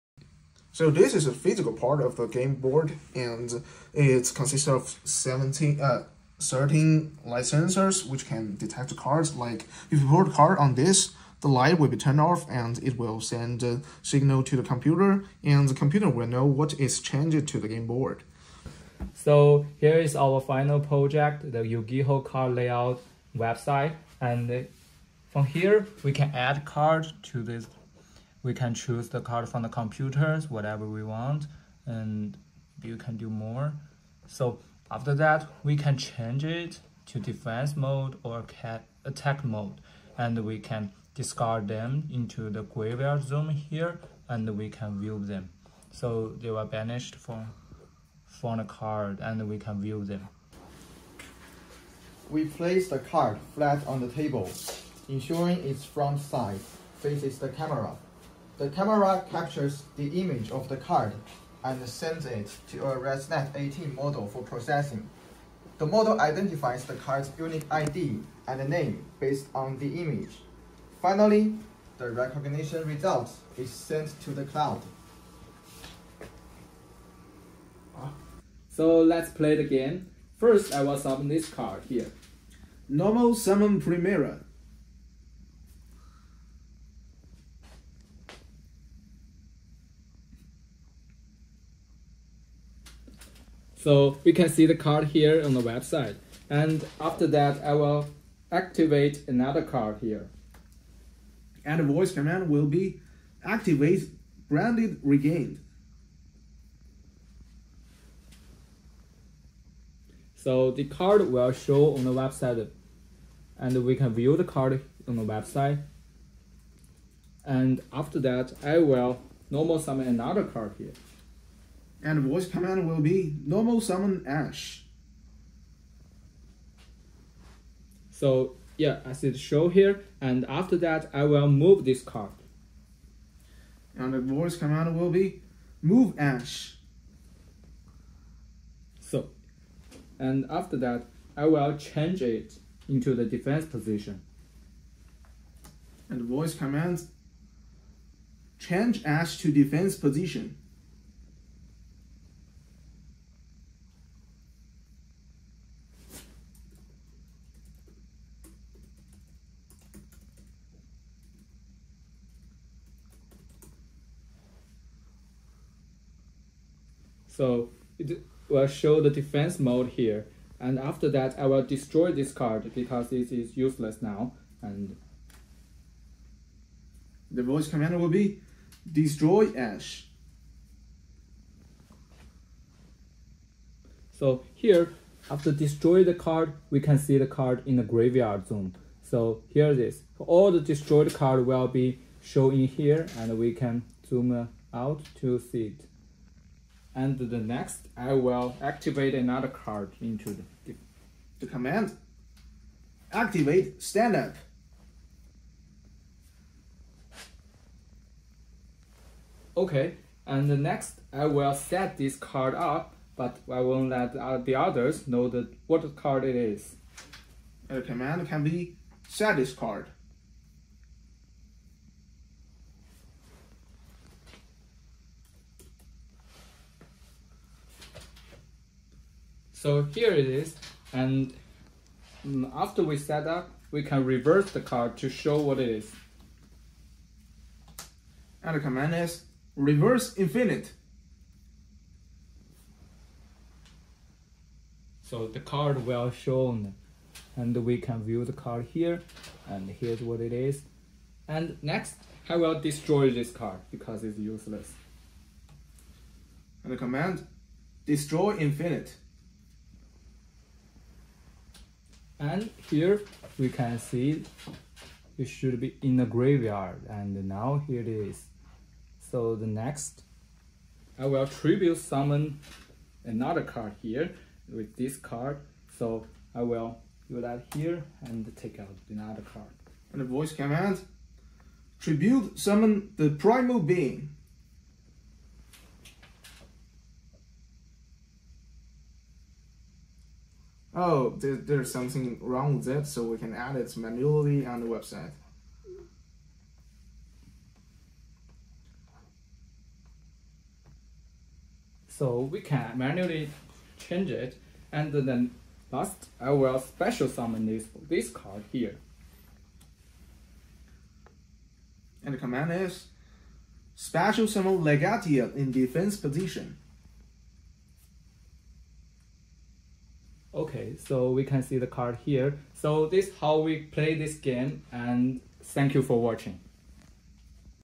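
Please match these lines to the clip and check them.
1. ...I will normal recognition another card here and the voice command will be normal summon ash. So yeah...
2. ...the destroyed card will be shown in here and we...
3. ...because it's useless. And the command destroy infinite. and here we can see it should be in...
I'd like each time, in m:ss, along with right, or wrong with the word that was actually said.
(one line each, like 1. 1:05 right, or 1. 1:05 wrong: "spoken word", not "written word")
1. 1:58 wrong: "summon", not "recognition"
2. 3:10 right
3. 4:13 right.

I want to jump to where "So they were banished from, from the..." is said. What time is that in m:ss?
0:45.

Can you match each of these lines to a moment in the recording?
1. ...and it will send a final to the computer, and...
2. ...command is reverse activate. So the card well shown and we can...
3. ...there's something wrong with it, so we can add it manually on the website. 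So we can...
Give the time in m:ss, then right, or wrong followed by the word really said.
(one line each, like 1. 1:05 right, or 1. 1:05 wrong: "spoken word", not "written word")
1. 0:12 wrong: "signal", not "final"
2. 3:58 wrong: "infinite", not "activate"
3. 4:51 right.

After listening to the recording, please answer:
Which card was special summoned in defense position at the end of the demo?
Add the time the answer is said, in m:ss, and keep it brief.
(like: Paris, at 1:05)
Legatia, at 5:14.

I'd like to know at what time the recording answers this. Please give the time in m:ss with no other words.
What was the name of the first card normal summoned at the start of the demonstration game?
1:23.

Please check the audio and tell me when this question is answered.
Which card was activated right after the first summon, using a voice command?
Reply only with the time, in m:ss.
1:44.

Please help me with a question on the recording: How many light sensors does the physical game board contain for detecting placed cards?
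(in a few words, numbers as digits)
13.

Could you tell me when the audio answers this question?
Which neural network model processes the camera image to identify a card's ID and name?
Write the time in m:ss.
1:02.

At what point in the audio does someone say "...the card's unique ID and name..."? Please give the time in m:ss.
1:06.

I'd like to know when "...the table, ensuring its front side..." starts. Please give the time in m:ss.
0:53.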